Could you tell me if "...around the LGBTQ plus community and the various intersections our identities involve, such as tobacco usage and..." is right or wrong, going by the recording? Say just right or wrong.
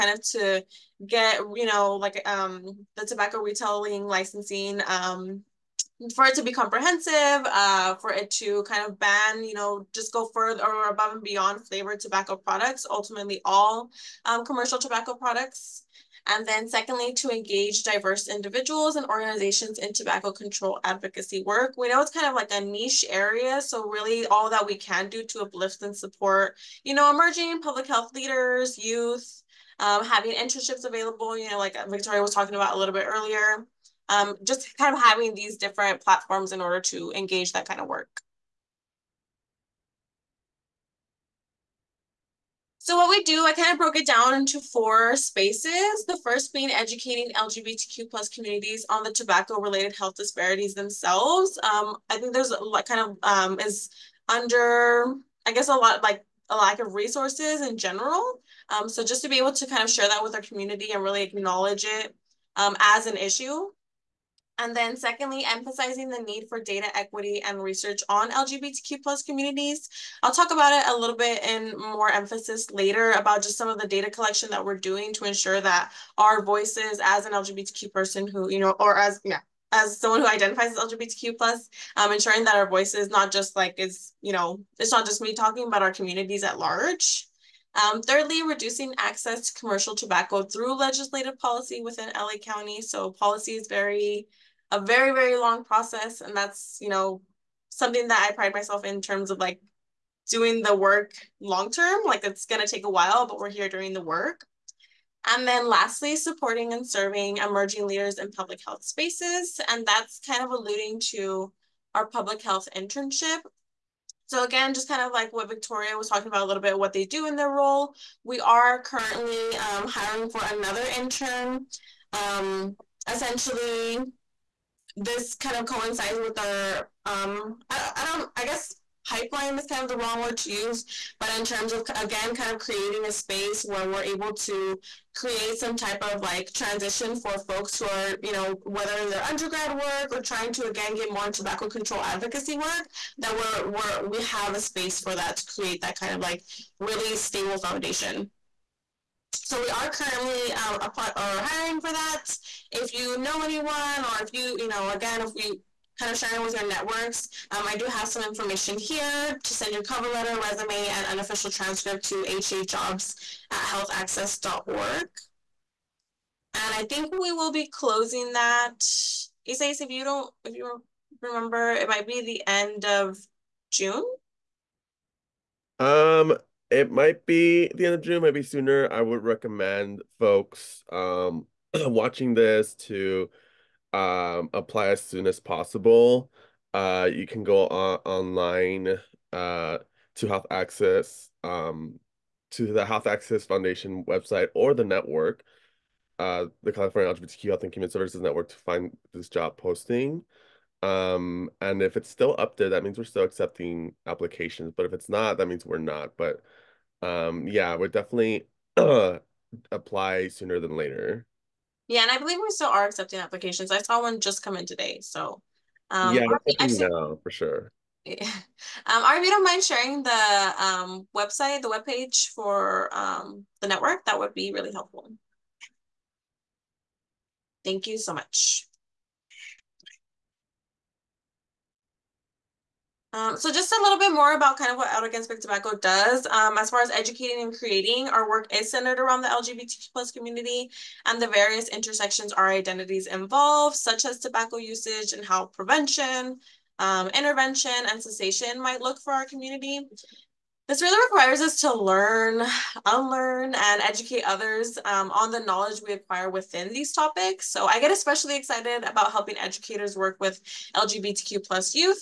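right.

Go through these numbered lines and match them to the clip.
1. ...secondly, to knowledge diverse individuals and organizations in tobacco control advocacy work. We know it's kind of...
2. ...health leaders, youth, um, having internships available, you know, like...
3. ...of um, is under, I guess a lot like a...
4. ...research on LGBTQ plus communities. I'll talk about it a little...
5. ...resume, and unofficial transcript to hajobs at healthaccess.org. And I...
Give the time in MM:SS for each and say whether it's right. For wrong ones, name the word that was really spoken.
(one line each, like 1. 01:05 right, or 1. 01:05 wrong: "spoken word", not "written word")
1. 00:16 wrong: "engage", not "knowledge"
2. 00:27 right
3. 00:52 right
4. 01:07 right
5. 02:40 right.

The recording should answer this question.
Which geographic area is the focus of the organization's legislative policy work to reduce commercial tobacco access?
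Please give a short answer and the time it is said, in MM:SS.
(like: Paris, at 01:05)
LA County, at 01:32.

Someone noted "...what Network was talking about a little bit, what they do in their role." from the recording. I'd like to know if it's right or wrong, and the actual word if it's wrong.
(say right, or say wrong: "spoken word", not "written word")
wrong: "Victoria", not "Network".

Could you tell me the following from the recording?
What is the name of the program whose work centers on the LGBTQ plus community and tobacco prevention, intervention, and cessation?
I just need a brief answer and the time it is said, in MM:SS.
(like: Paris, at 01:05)
Out Against Big Tobacco, at 03:54.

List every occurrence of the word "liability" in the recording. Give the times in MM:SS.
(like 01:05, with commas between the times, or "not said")
not said.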